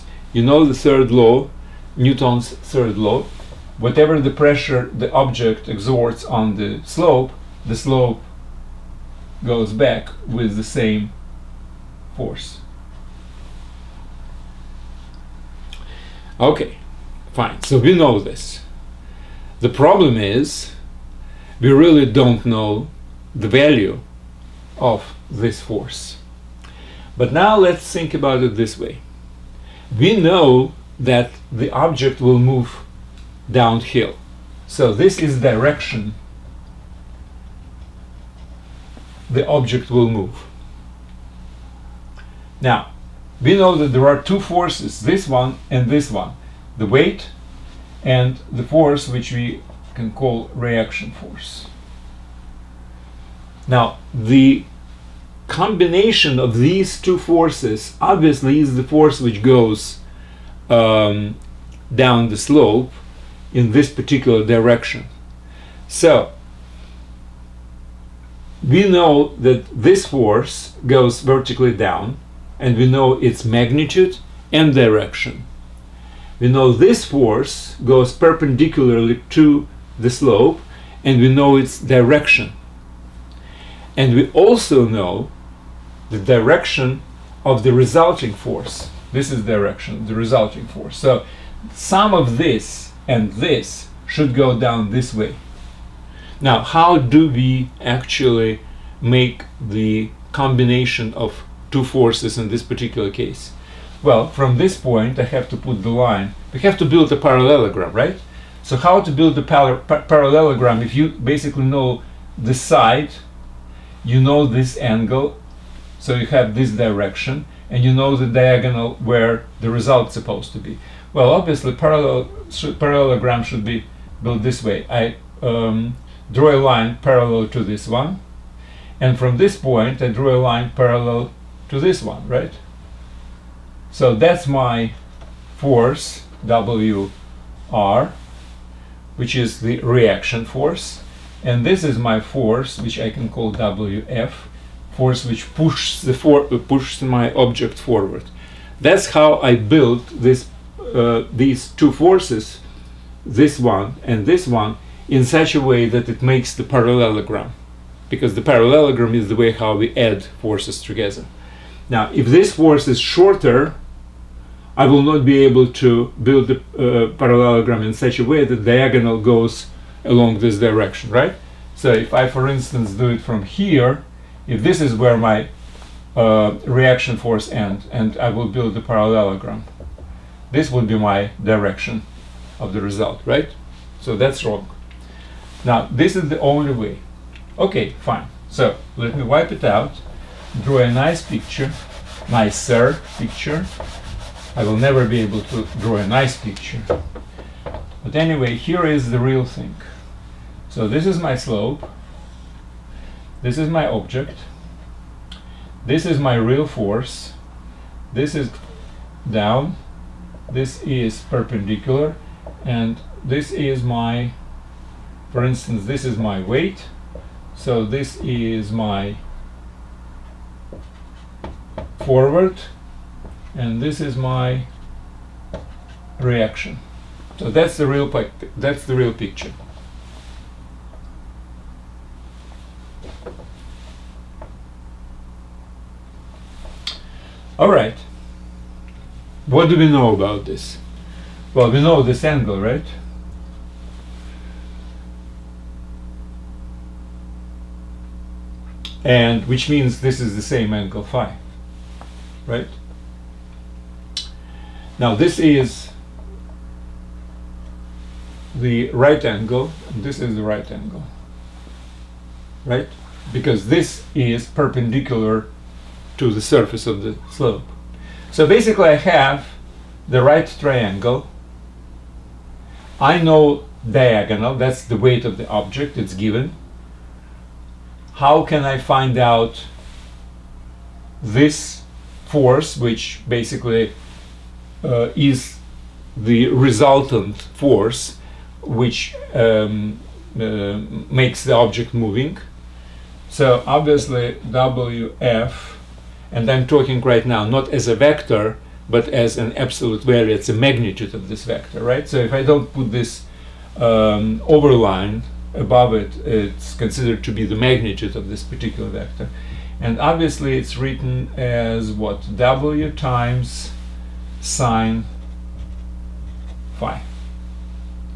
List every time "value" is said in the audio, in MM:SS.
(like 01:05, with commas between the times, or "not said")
00:23, 05:00.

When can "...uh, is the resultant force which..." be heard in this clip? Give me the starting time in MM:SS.
04:44.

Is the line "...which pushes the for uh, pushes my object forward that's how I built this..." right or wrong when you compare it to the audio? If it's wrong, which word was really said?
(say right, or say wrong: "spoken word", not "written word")
right.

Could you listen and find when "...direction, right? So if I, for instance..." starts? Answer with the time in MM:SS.
02:50.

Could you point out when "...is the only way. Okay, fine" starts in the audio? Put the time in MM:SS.
03:06.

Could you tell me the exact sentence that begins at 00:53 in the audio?
Now, the combination of these two forces obviously is the force which goes um, down the slope in this particular direction.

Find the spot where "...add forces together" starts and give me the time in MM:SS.
02:39.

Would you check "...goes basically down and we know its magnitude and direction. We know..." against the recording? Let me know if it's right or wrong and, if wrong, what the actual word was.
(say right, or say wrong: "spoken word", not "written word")
wrong: "vertically", not "basically".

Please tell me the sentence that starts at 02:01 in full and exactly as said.
Well, obviously, parallel parallelogram should be built this way.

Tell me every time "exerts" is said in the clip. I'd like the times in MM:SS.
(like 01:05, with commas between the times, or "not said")
00:05.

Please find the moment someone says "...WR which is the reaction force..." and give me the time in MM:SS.
02:16.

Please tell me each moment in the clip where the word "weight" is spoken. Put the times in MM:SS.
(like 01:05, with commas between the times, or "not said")
00:46, 03:36, 04:34.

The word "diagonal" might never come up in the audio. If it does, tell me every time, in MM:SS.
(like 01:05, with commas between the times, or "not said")
01:58, 02:48, 04:33.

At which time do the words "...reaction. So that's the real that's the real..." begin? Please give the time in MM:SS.
03:46.